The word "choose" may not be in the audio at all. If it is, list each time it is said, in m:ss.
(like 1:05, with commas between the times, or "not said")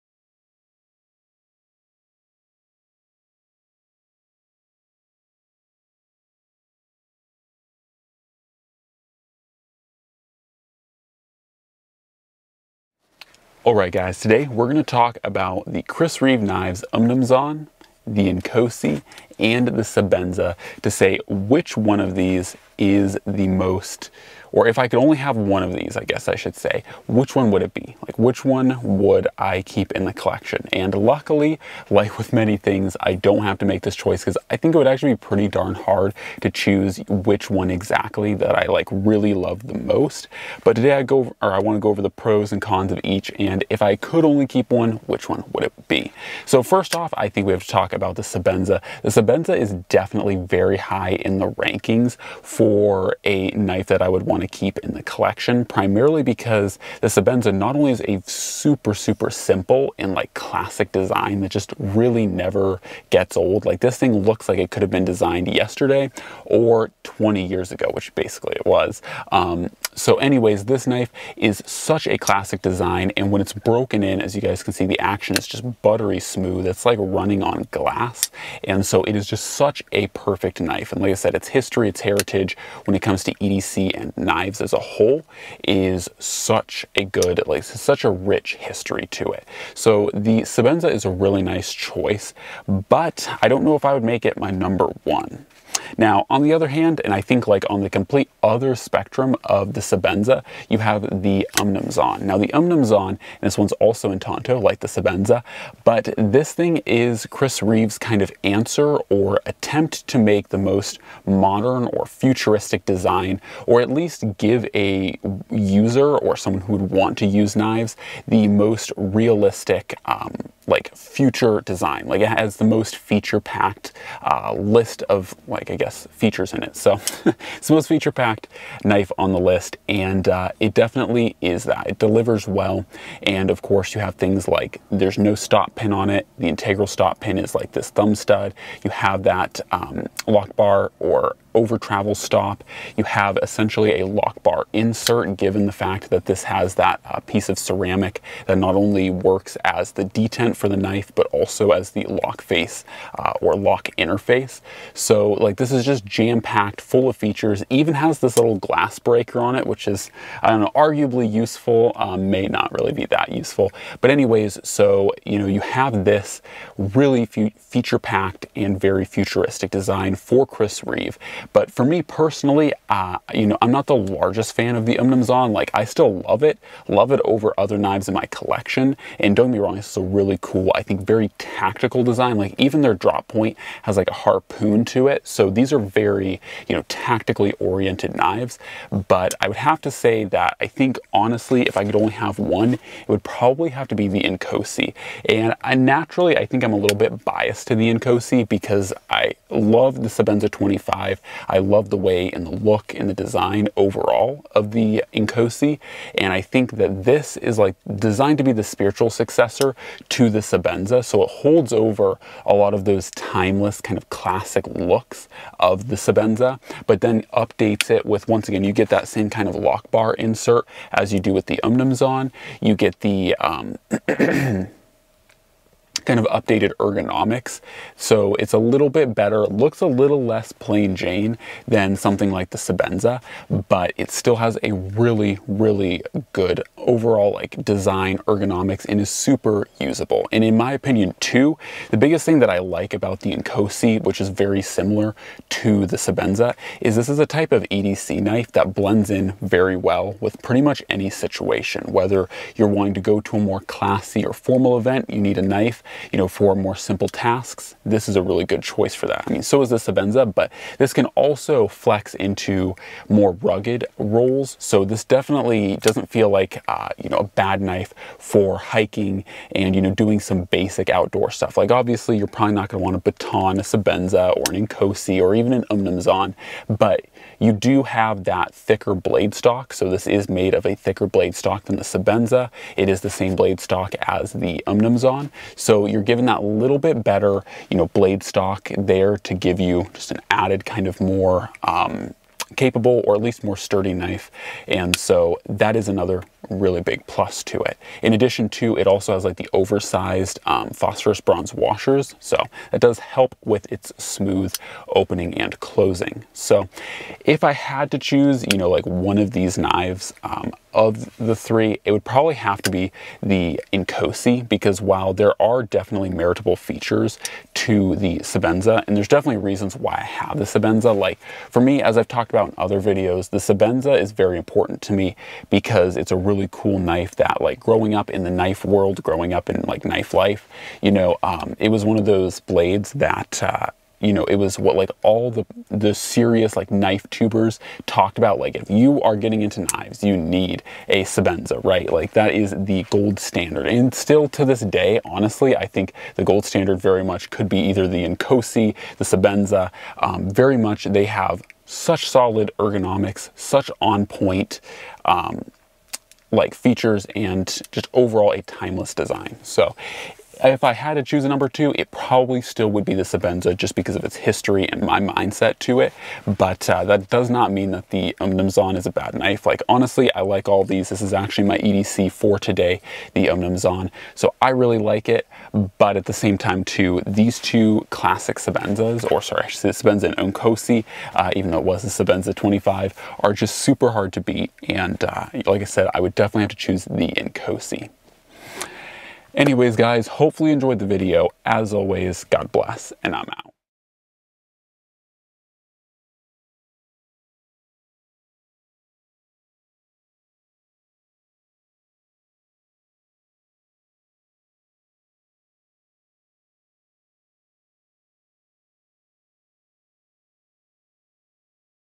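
0:36, 5:07, 6:01, 6:26.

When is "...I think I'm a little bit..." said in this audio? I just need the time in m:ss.
3:16.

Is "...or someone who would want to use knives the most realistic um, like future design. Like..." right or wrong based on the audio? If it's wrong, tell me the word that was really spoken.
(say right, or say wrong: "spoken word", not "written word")
right.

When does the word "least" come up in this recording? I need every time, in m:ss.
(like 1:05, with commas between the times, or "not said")
1:53, 4:53.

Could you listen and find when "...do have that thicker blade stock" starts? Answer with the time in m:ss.
4:37.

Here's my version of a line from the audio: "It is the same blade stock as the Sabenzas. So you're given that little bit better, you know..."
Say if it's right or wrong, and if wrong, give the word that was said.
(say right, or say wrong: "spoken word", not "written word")
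wrong: "Umnumzaan", not "Sabenzas".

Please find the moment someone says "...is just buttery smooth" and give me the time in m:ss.
1:15.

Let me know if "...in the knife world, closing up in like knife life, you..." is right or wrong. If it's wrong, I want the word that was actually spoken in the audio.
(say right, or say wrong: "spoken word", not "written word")
wrong: "growing", not "closing".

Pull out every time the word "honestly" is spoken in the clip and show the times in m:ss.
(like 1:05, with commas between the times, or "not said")
3:11, 5:45, 6:09.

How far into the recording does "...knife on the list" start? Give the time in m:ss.
2:08.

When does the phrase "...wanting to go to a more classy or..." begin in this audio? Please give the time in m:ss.
4:12.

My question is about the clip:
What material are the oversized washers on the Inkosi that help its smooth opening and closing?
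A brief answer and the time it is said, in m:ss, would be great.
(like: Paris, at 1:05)
phosphorus bronze, at 5:00.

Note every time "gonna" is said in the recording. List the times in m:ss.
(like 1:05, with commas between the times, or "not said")
4:32.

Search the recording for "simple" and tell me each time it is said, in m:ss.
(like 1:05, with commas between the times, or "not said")
0:59, 4:16.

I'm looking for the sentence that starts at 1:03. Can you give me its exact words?
Like this thing looks like it could have been designed yesterday or 20 years ago, which basically it was.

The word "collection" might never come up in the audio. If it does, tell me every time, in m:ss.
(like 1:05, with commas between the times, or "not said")
0:30, 0:55, 2:58.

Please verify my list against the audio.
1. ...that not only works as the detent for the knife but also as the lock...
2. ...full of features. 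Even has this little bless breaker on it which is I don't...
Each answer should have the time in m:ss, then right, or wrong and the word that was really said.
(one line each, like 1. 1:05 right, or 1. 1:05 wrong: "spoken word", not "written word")
1. 2:28 right
2. 2:36 wrong: "glass", not "bless".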